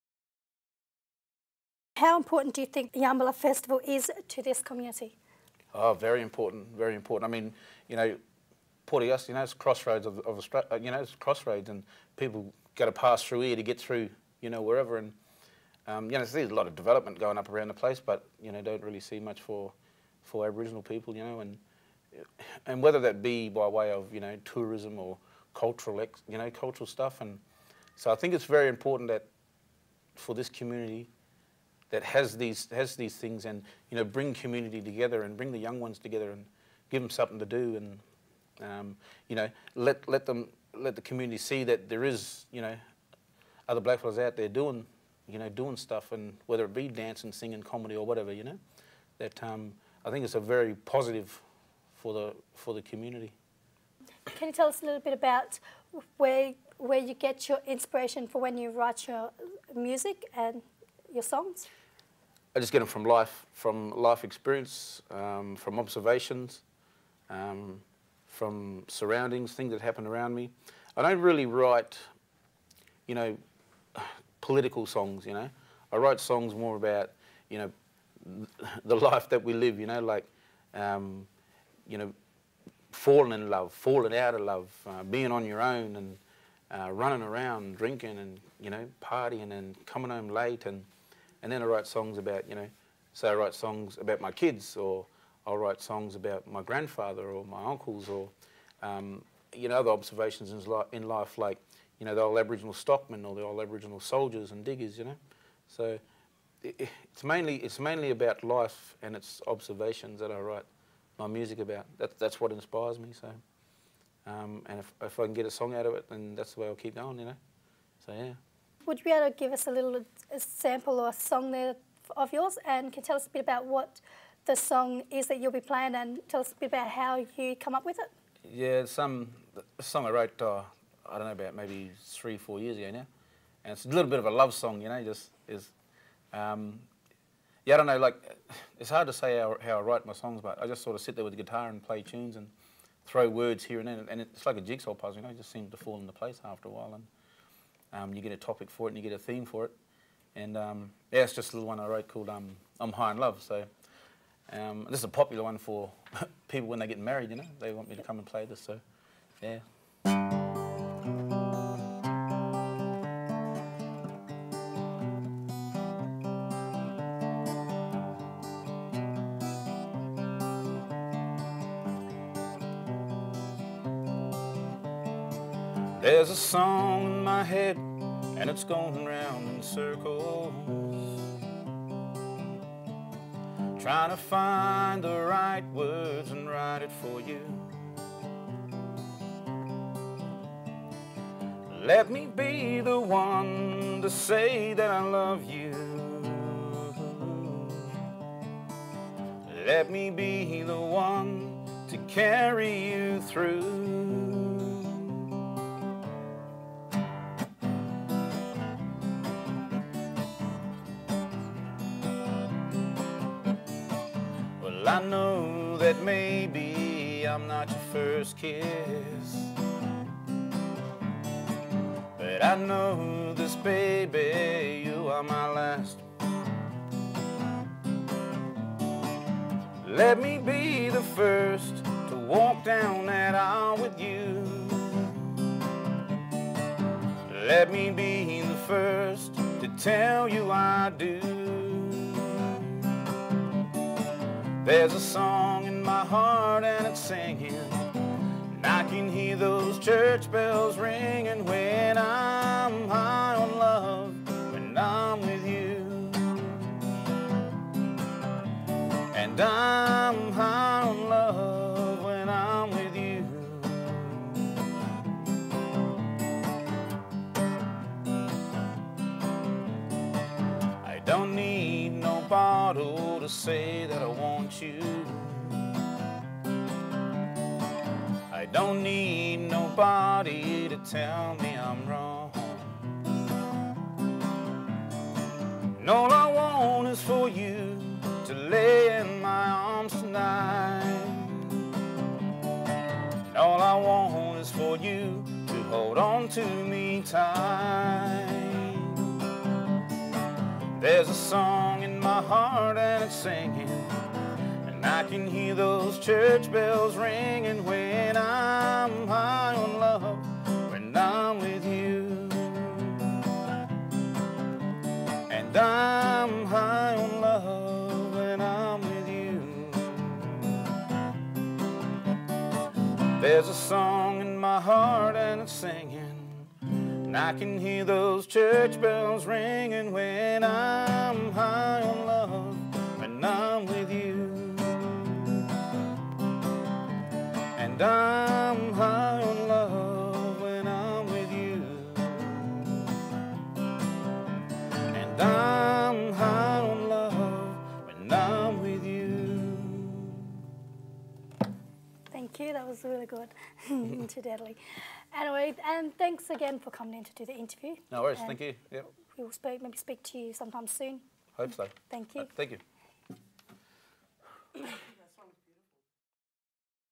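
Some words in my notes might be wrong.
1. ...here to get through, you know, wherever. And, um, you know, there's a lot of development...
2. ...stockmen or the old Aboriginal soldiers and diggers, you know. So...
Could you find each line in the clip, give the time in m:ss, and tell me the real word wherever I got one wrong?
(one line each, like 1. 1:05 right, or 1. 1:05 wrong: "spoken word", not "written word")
1. 0:13 right
2. 1:42 right.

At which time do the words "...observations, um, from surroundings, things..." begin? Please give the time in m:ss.
1:05.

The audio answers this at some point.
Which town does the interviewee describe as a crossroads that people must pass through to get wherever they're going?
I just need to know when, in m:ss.
0:08.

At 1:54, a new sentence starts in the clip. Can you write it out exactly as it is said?
Um, and if, if I can get a song out of it, then that's the way I'll keep going, you know.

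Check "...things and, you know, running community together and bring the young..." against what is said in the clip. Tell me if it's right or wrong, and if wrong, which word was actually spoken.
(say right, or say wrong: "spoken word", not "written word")
wrong: "bring", not "running".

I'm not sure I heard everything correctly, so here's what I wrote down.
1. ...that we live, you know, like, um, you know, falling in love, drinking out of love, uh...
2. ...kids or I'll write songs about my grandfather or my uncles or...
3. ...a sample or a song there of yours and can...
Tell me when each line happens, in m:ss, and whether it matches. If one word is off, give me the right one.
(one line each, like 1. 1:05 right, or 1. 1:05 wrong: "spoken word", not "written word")
1. 1:19 wrong: "falling", not "drinking"
2. 1:34 right
3. 2:00 right.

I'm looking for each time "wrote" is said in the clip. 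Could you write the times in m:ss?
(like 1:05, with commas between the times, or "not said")
2:10, 2:31.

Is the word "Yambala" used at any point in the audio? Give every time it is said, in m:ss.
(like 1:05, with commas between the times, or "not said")
0:03.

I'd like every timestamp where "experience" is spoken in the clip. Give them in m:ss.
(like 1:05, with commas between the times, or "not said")
1:04.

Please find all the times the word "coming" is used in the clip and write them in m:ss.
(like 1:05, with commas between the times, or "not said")
1:29, 5:56.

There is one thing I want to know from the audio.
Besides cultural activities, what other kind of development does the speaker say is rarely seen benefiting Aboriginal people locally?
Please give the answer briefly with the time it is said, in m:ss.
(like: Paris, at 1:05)
Tourism, at 0:24.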